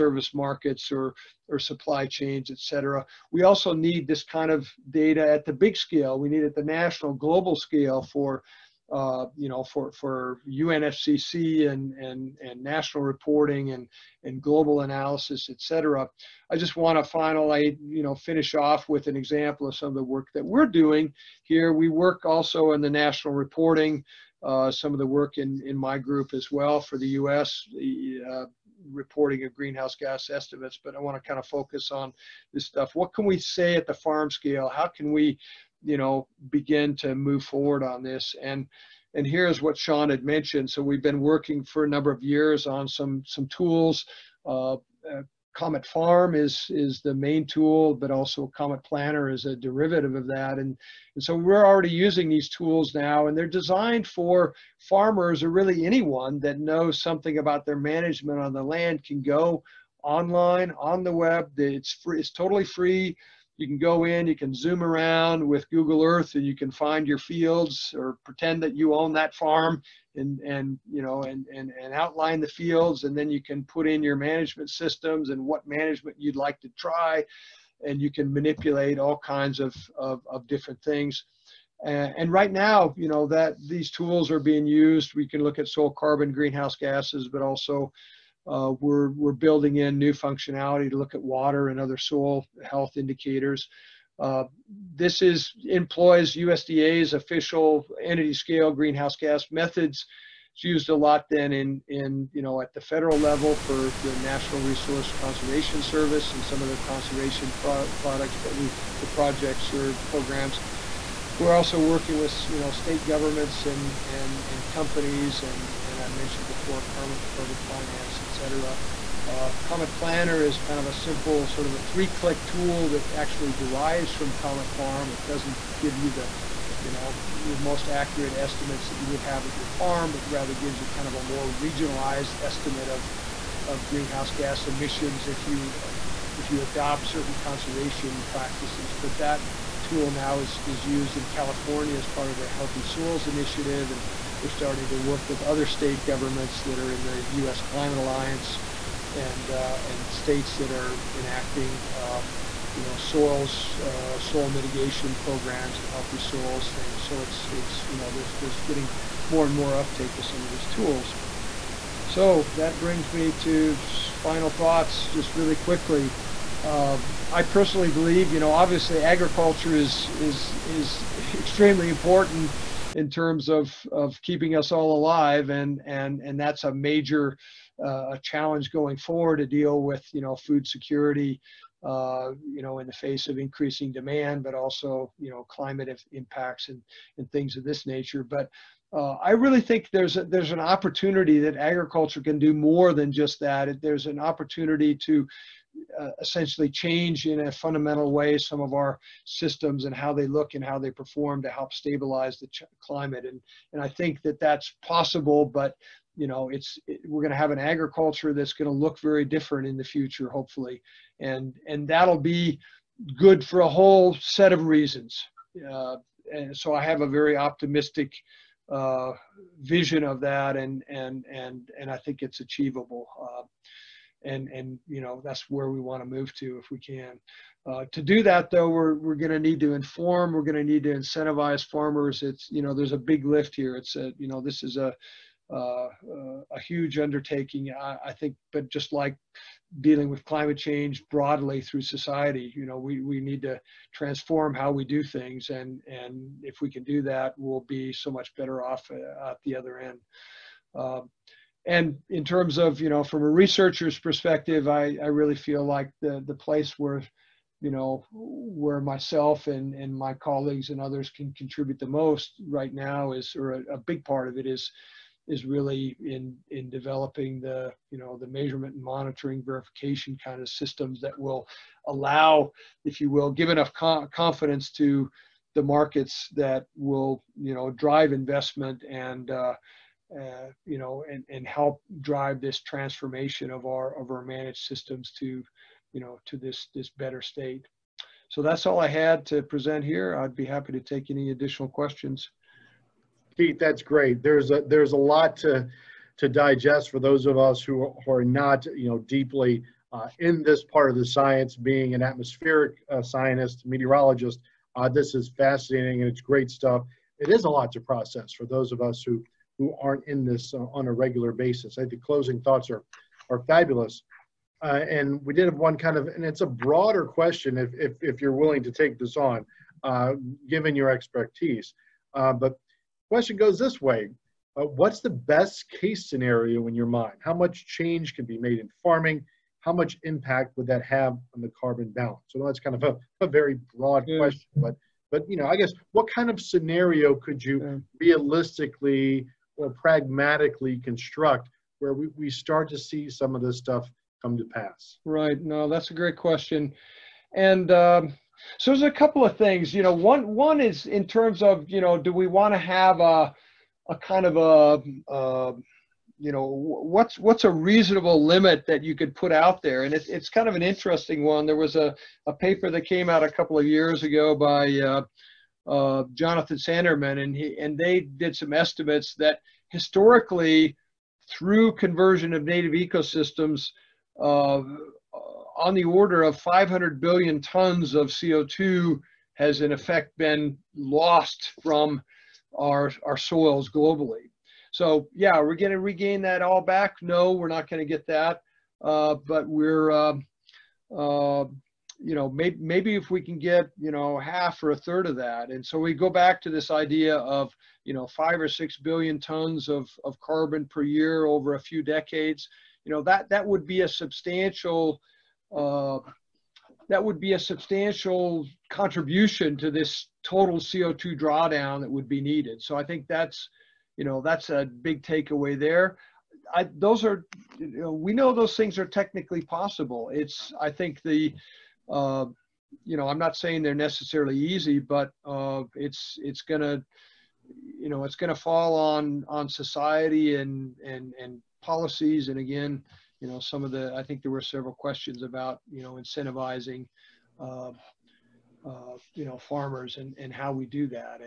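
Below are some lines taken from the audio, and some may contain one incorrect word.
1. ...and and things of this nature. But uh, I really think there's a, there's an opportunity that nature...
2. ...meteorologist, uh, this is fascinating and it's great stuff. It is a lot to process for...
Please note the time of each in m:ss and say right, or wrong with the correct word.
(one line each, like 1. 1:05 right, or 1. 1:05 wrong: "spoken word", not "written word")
1. 3:06 wrong: "agriculture", not "nature"
2. 5:03 right.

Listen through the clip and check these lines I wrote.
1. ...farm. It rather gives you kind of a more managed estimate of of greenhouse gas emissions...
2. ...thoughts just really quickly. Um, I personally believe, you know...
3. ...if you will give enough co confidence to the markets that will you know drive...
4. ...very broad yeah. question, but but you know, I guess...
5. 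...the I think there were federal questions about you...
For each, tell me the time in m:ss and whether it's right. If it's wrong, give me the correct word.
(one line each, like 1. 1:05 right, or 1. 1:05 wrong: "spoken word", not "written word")
1. 2:09 wrong: "regionalized", not "managed"
2. 2:44 right
3. 4:32 right
4. 5:33 right
5. 7:13 wrong: "several", not "federal".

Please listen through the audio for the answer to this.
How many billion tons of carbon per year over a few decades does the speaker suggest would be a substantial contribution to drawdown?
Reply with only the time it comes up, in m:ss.
6:38.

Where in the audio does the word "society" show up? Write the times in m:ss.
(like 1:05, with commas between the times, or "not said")
4:01, 7:09.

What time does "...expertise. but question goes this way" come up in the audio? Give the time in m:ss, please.
5:20.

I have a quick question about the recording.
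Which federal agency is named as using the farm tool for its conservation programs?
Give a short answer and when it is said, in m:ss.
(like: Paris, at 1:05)
National Resource Conservation Service, at 1:44.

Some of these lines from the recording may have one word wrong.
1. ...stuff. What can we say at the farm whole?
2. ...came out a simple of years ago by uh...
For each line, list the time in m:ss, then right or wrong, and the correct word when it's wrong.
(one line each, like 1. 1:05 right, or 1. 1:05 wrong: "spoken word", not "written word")
1. 0:32 wrong: "scale", not "whole"
2. 6:02 wrong: "couple", not "simple".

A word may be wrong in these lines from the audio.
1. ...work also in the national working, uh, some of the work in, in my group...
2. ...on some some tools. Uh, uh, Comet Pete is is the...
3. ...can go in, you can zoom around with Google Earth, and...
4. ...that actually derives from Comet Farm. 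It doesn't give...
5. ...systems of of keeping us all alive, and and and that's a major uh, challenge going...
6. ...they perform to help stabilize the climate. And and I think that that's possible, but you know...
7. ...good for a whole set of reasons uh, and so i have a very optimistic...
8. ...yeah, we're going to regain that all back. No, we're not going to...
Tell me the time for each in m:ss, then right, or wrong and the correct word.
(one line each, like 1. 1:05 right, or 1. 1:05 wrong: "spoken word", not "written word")
1. 0:21 wrong: "reporting", not "working"
2. 0:42 wrong: "Farm", not "Pete"
3. 1:03 right
4. 2:02 right
5. 2:53 wrong: "terms", not "systems"
6. 3:20 right
7. 3:33 right
8. 6:25 right.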